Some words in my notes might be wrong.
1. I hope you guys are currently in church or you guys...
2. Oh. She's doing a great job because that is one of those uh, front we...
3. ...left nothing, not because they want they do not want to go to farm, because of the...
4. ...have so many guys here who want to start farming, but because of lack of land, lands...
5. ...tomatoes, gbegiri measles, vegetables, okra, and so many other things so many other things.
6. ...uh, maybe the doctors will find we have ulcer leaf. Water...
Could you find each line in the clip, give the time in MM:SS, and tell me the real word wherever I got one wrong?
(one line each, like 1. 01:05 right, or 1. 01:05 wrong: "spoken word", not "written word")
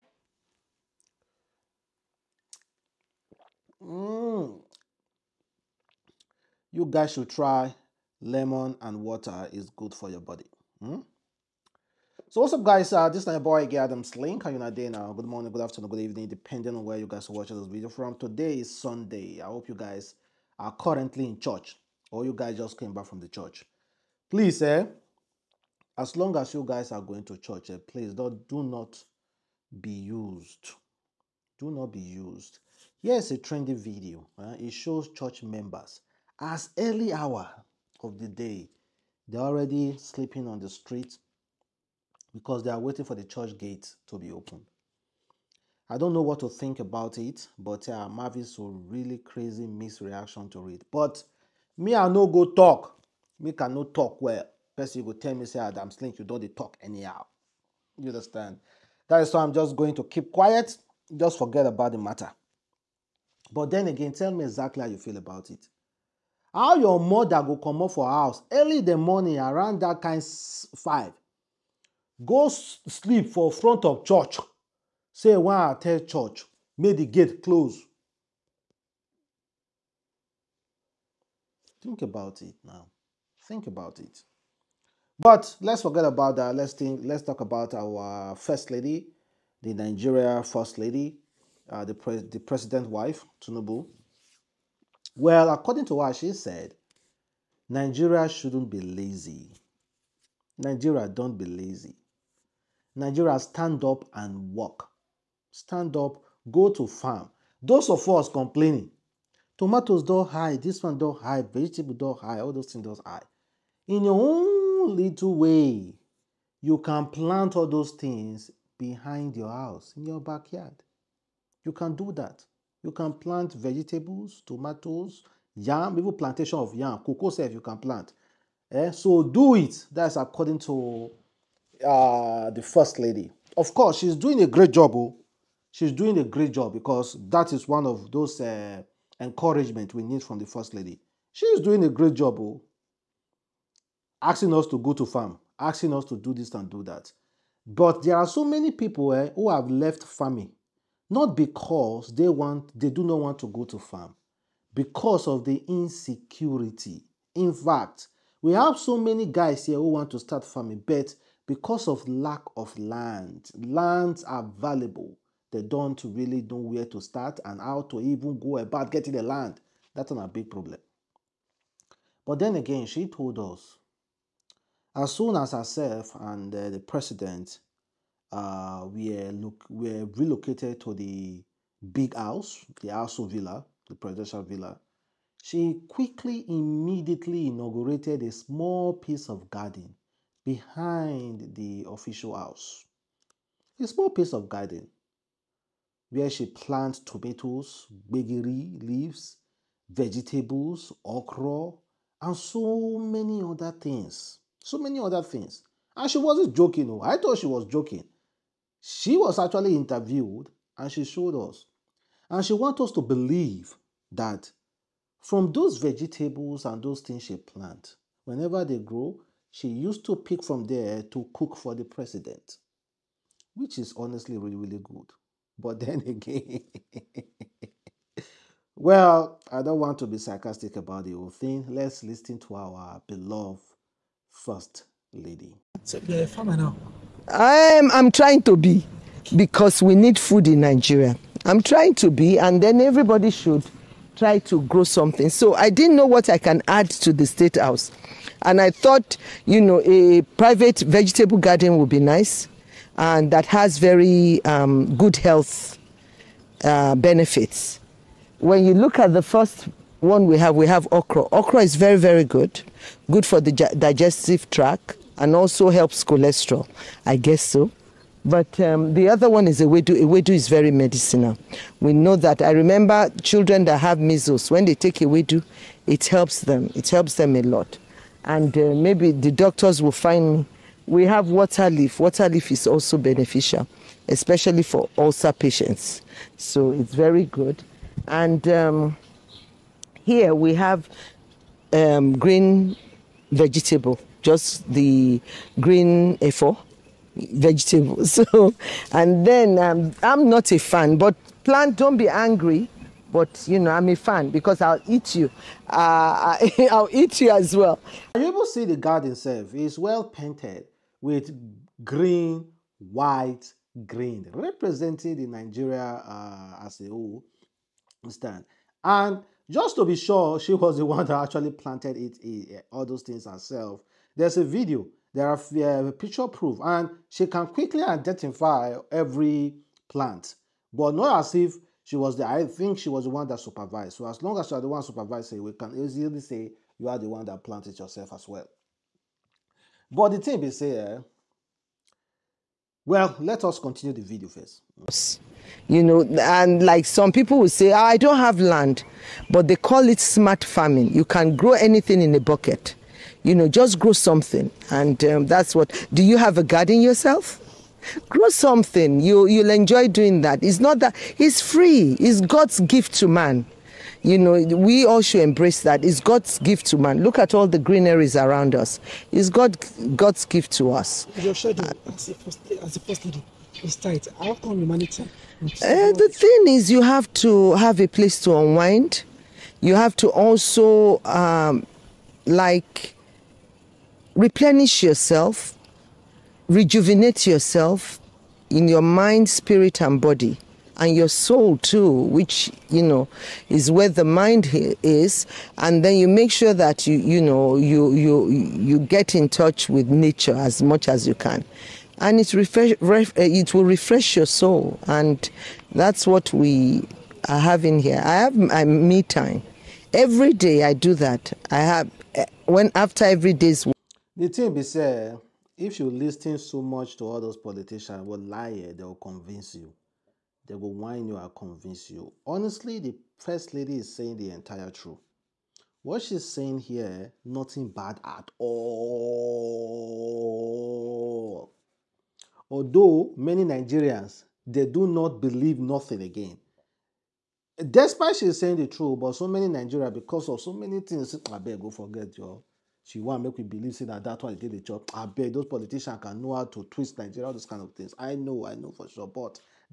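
1. 00:19 right
2. 02:14 wrong: "encouragement", not "front"
3. 02:29 wrong: "farming", not "nothing"
4. 02:38 right
5. 03:17 wrong: "leaves", not "measles"
6. 04:38 wrong: "water", not "ulcer".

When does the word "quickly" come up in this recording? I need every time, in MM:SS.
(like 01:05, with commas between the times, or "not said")
03:05, 05:27.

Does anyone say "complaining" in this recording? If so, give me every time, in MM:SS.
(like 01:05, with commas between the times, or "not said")
01:48.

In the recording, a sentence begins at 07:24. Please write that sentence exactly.
I beg those politicians can know how to twist Nigeria, all those kind of things.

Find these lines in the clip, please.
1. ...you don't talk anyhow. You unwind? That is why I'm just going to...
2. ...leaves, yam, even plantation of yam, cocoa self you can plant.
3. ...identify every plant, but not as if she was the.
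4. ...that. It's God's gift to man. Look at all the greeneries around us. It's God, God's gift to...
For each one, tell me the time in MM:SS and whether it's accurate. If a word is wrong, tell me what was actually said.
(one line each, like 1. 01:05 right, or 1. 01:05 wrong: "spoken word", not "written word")
1. 00:56 wrong: "understand", not "unwind"
2. 02:04 wrong: "tomatoes", not "leaves"
3. 05:27 right
4. 06:05 right.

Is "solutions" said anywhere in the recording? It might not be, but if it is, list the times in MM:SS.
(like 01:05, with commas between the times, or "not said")
not said.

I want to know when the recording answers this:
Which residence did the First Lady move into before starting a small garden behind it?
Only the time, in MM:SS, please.
03:02.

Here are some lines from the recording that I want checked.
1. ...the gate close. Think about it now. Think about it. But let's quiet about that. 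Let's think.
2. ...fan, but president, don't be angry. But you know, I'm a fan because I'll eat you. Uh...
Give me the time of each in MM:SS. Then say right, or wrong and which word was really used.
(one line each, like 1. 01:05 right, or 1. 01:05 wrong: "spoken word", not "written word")
1. 01:16 wrong: "forget", not "quiet"
2. 05:00 wrong: "plant", not "president".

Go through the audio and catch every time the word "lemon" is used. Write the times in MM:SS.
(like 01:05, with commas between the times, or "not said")
00:08.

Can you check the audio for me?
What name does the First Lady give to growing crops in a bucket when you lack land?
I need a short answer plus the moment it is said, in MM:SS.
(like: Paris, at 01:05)
Smart farming, at 05:49.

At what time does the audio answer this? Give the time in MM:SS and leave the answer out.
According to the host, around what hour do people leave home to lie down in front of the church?
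01:10.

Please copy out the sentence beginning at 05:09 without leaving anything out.
It's well painted with green, white, green, representing the Nigeria uh, as a whole.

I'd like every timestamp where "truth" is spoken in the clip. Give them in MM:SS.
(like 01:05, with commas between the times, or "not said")
07:04, 07:18.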